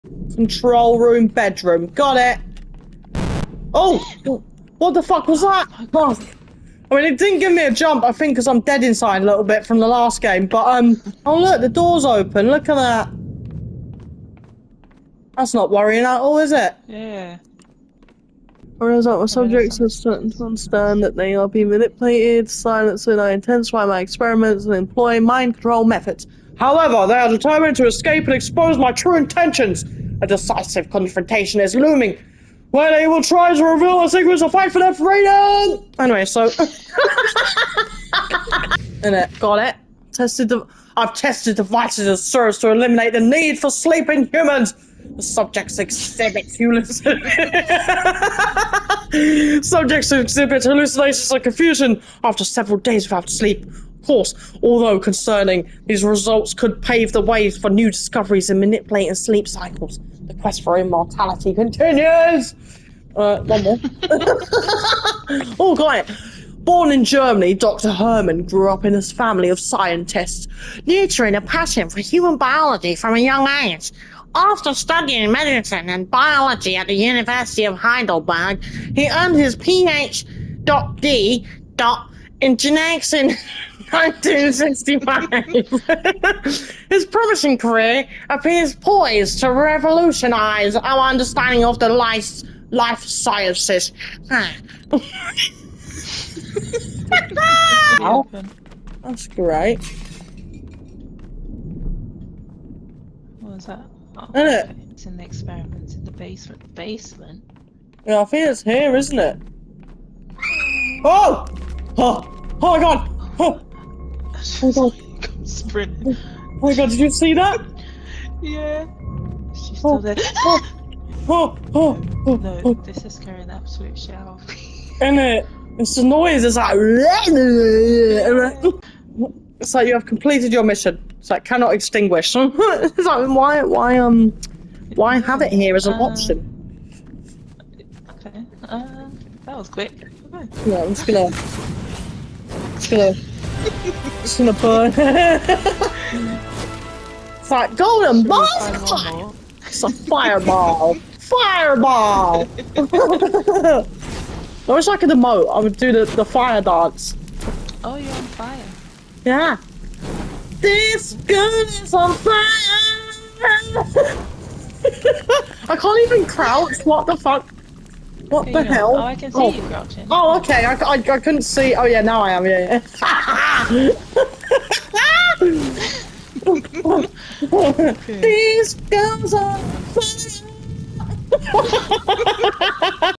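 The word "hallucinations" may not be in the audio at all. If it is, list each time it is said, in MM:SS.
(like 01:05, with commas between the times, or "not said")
00:46, 00:50.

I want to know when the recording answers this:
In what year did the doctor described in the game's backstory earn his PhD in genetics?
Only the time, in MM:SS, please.
01:23.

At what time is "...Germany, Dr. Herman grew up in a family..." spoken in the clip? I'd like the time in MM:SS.
01:07.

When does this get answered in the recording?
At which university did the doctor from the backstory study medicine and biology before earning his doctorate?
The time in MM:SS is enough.
01:16.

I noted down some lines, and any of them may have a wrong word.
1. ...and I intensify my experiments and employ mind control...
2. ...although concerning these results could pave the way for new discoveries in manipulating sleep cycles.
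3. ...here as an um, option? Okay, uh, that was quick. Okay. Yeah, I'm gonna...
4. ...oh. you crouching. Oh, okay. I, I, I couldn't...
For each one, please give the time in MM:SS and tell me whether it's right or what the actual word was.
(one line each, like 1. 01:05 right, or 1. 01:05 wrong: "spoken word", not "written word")
1. 00:23 right
2. 00:54 right
3. 02:15 right
4. 02:49 right.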